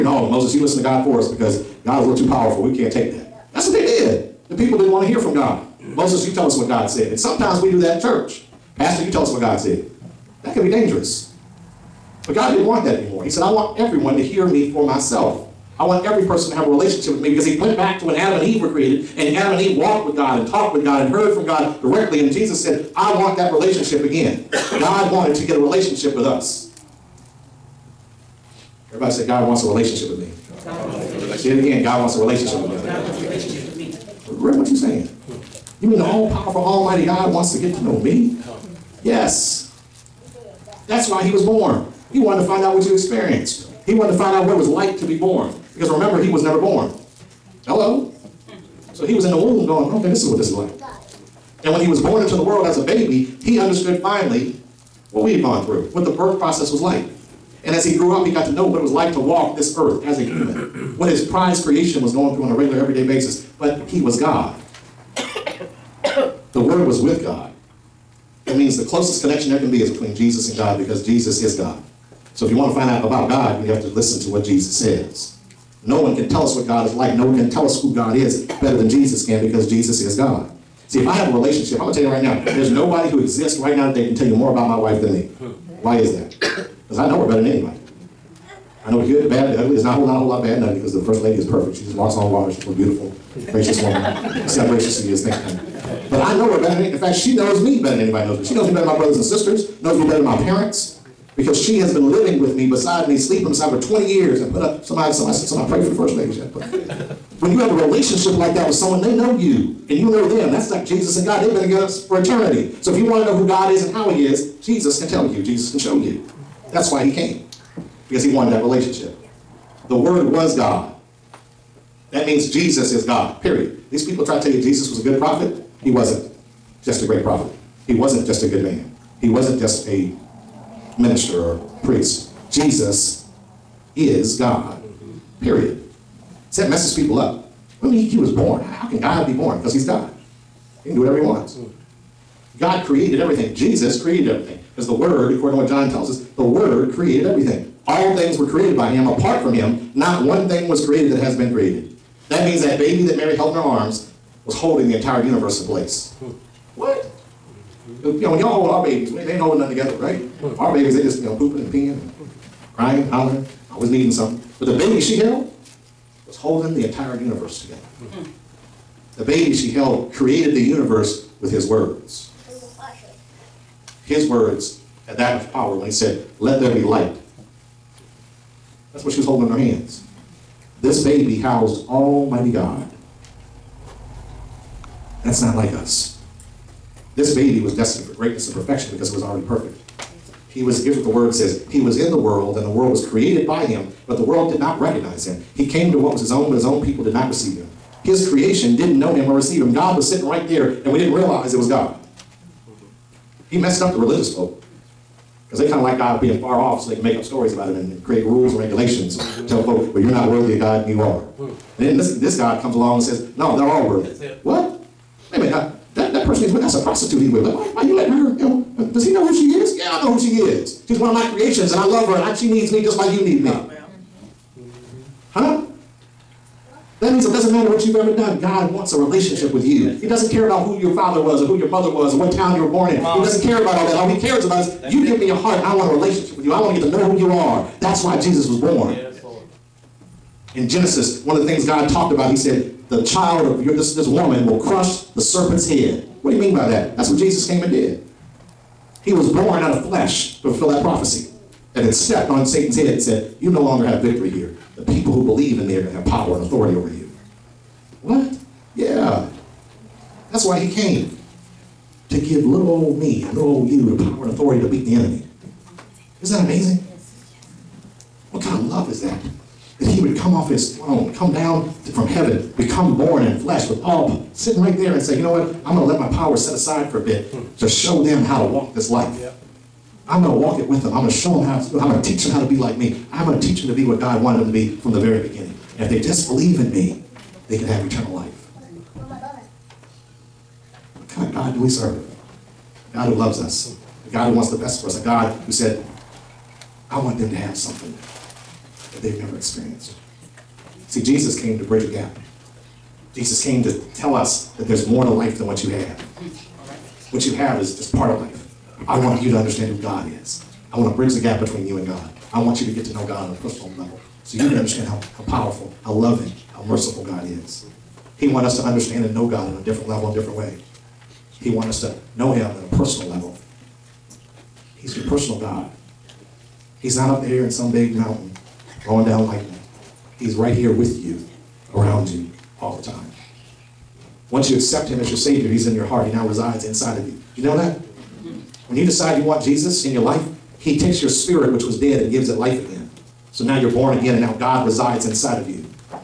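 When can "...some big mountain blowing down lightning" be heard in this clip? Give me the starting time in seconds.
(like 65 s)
327 s.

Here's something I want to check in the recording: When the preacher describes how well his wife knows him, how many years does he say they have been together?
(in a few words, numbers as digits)
20.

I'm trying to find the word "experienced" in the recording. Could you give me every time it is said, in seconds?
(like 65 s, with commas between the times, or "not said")
42 s, 299 s.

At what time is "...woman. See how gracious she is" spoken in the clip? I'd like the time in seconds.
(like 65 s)
93 s.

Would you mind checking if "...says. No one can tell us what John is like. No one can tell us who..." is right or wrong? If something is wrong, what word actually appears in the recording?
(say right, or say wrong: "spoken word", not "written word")
wrong: "God", not "John".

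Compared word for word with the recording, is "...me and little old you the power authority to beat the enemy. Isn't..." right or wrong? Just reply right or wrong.
right.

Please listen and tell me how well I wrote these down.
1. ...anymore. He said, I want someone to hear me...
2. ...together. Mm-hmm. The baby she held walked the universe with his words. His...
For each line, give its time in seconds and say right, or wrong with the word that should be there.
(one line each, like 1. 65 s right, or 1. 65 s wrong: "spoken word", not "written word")
1. 12 s wrong: "everyone", not "someone"
2. 167 s wrong: "created", not "walked".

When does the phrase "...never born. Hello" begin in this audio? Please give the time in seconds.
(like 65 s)
46 s.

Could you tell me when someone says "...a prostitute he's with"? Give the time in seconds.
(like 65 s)
216 s.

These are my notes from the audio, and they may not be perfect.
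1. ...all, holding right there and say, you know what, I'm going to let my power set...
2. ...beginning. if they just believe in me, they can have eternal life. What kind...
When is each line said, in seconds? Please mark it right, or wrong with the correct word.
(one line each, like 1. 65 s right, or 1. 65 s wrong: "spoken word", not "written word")
1. 273 s wrong: "sitting", not "holding"
2. 285 s right.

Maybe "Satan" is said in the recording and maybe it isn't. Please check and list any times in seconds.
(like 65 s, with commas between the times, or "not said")
252 s.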